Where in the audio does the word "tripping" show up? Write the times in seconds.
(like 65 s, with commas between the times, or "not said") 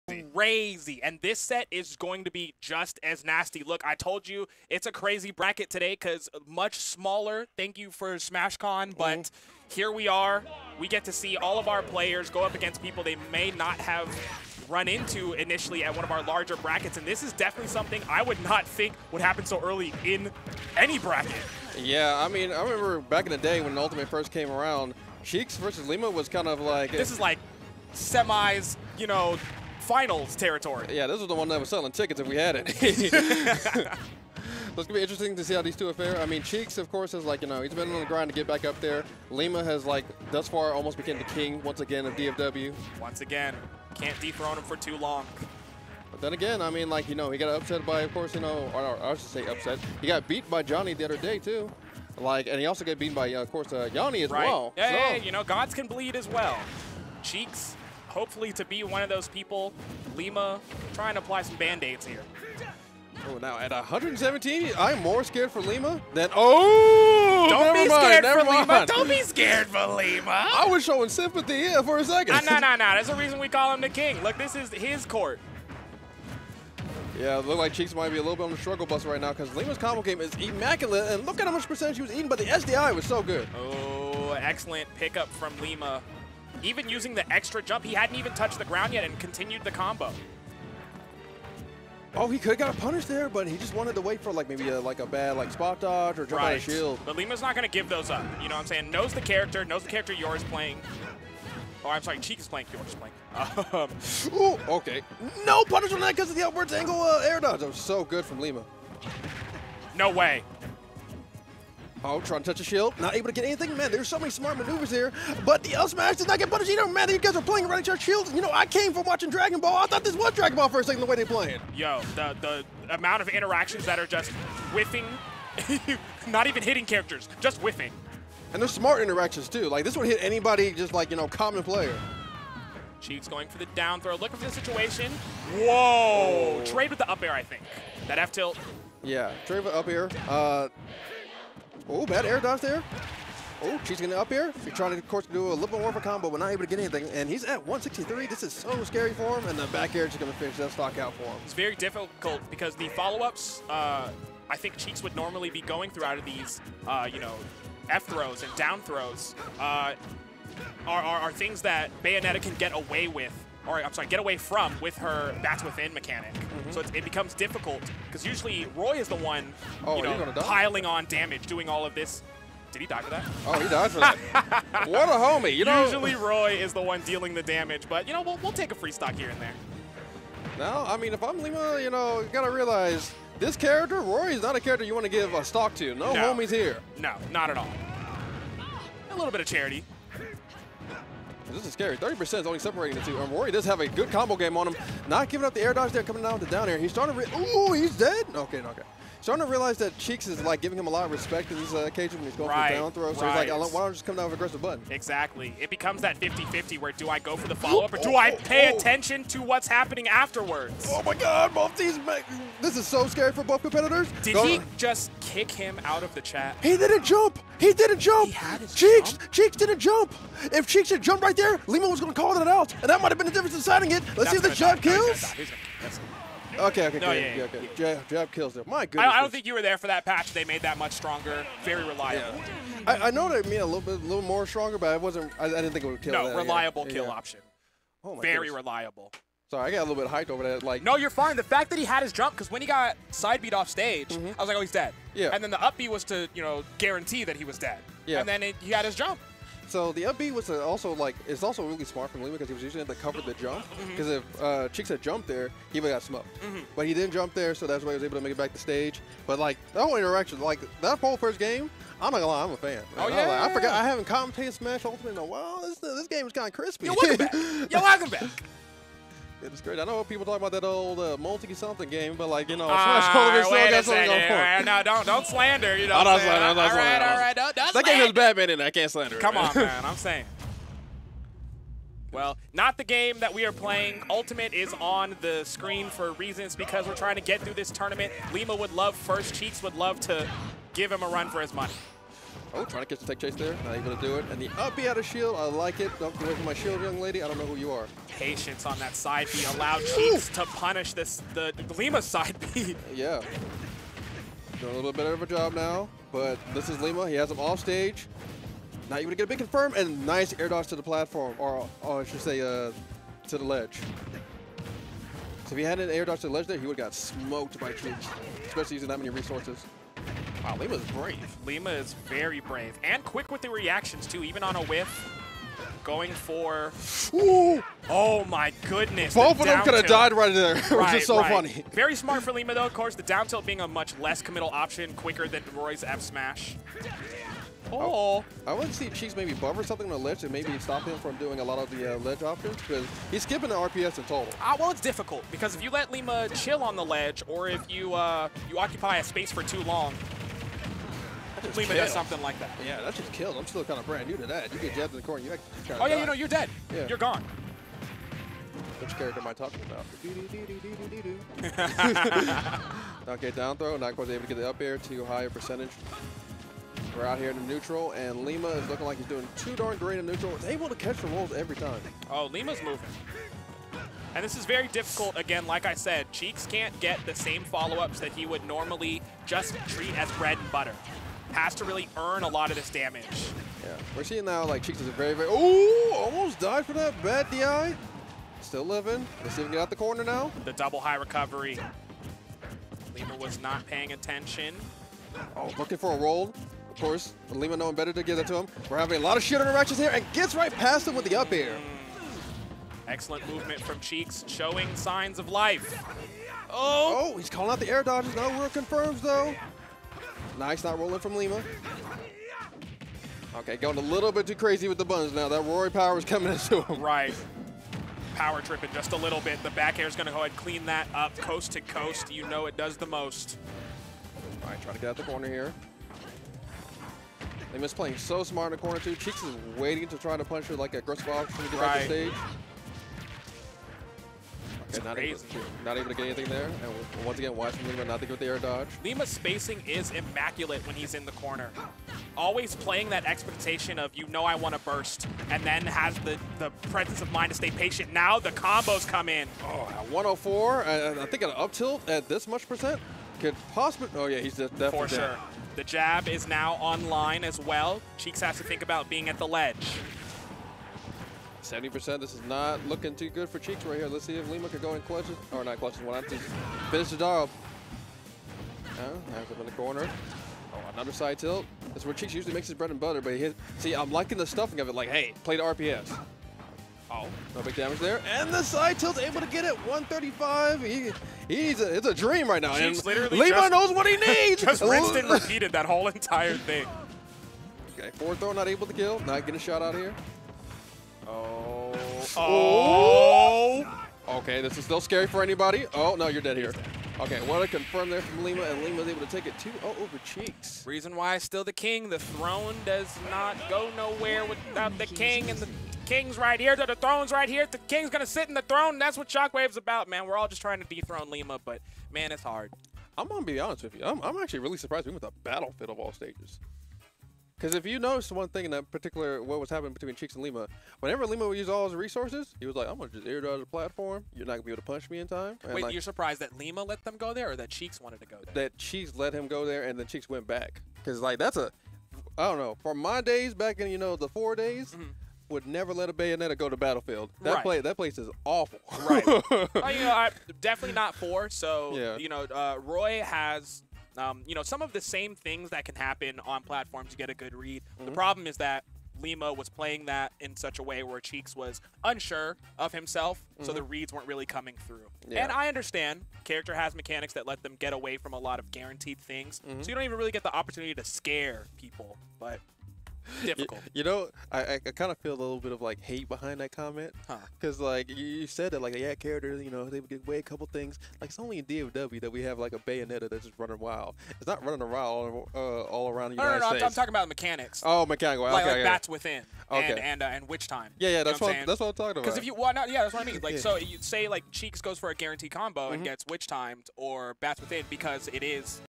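418 s.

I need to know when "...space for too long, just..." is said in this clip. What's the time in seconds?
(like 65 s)
349 s.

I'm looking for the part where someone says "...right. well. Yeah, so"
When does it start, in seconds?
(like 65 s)
54 s.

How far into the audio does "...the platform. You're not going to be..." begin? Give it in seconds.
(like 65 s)
523 s.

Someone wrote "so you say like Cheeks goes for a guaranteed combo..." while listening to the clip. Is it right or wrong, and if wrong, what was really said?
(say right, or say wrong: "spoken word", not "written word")
right.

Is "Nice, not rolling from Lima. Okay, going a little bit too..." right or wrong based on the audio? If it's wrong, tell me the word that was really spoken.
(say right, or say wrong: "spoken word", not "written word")
right.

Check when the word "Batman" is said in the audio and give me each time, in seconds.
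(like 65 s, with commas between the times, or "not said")
278 s.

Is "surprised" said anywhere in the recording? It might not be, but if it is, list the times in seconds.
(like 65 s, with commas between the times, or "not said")
514 s, 525 s.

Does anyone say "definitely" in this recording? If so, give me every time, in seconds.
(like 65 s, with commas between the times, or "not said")
17 s, 454 s, 540 s.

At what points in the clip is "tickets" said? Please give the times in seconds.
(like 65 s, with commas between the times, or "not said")
31 s.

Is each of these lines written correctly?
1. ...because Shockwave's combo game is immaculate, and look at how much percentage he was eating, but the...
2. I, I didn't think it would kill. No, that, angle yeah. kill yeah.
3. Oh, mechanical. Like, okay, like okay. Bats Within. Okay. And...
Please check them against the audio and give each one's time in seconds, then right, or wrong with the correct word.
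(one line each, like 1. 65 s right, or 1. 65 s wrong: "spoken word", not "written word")
1. 79 s wrong: "Lima", not "Shockwave"
2. 235 s wrong: "reliable", not "angle"
3. 577 s right.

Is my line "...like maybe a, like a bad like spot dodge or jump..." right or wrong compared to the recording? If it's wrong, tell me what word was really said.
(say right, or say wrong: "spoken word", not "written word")
right.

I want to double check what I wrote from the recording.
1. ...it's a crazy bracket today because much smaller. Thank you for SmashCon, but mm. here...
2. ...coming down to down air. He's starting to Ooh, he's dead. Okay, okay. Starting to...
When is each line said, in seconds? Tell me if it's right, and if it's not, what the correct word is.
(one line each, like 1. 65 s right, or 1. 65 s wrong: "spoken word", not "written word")
1. 4 s right
2. 196 s right.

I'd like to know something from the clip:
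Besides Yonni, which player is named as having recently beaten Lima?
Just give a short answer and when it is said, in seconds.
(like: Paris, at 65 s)
Jonhy, at 50 s.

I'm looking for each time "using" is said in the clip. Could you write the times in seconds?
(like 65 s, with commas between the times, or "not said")
86 s, 252 s, 318 s.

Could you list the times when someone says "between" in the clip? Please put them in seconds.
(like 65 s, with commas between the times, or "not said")
519 s.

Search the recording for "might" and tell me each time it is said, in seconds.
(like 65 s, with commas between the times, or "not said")
77 s, 223 s.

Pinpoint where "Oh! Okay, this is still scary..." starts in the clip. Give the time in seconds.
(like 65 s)
494 s.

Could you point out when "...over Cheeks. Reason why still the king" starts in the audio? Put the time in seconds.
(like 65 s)
499 s.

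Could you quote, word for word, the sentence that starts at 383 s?
Yeah, we're seeing now like Cheeks is a very, very, oh, almost died for that bad DI.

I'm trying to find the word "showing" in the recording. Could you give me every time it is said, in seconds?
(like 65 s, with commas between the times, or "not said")
70 s, 404 s.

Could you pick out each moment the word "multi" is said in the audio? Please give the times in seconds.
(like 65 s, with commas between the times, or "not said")
271 s.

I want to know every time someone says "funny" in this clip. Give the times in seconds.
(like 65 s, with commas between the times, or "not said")
331 s.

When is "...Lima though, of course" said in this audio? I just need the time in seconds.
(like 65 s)
332 s.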